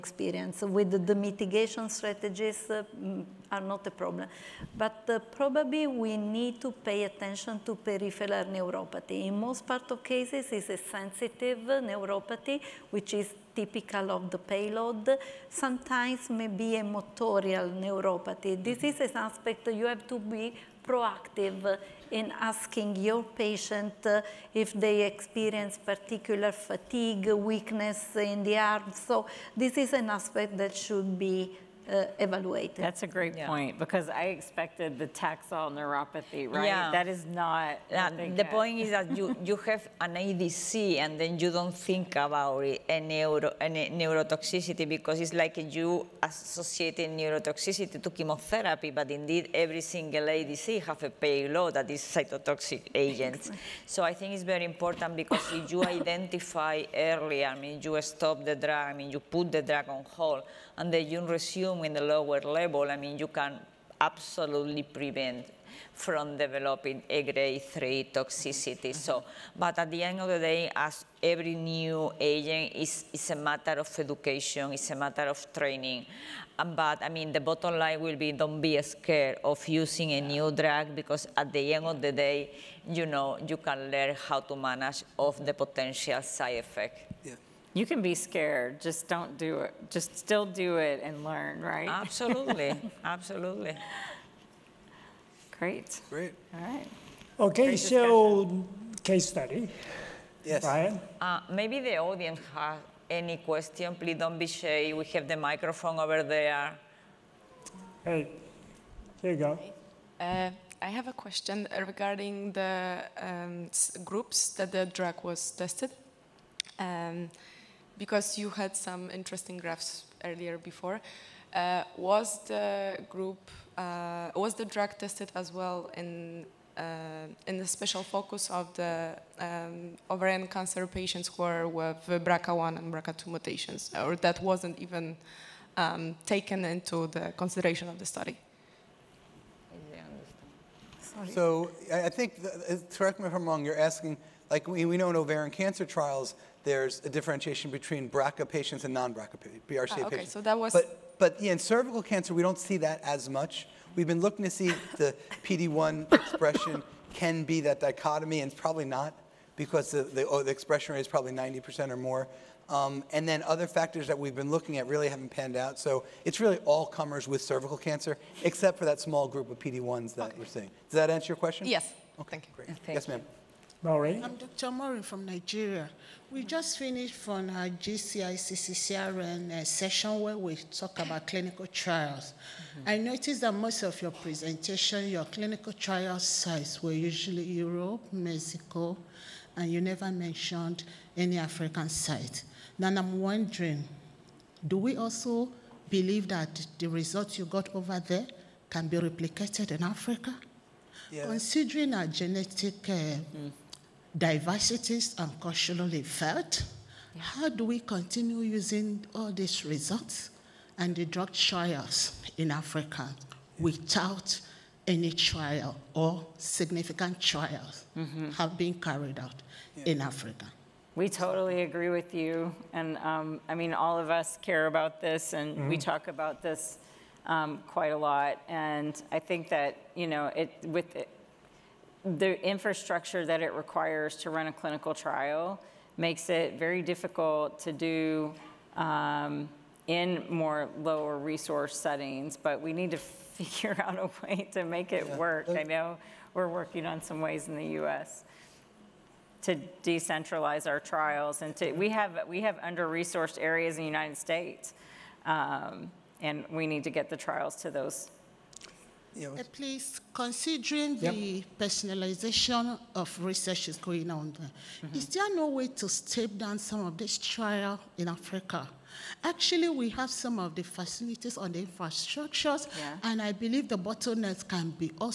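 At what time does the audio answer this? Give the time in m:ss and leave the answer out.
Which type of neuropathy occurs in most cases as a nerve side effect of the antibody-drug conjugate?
0:10.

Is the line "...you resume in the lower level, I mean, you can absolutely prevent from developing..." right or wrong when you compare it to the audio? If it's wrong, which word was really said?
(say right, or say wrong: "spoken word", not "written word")
right.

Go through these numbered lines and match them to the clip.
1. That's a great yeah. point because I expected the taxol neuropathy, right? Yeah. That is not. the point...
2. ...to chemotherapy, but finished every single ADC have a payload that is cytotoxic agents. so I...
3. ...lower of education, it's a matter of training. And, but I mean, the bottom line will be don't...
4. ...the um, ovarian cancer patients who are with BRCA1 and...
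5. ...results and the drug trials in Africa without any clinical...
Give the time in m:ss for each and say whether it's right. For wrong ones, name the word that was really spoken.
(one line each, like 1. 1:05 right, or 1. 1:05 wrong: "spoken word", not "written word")
1. 0:32 right
2. 0:48 wrong: "indeed", not "finished"
3. 1:13 wrong: "matter", not "lower"
4. 2:08 right
5. 3:29 wrong: "trial", not "clinical".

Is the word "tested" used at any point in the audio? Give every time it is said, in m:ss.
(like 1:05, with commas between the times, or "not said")
1:55, 2:04.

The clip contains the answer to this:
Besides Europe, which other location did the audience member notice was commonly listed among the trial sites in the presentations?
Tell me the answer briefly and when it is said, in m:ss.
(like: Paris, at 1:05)
Mexico, at 3:08.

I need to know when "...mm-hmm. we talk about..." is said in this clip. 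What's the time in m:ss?
3:45.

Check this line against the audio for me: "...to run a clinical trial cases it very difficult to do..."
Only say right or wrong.
wrong.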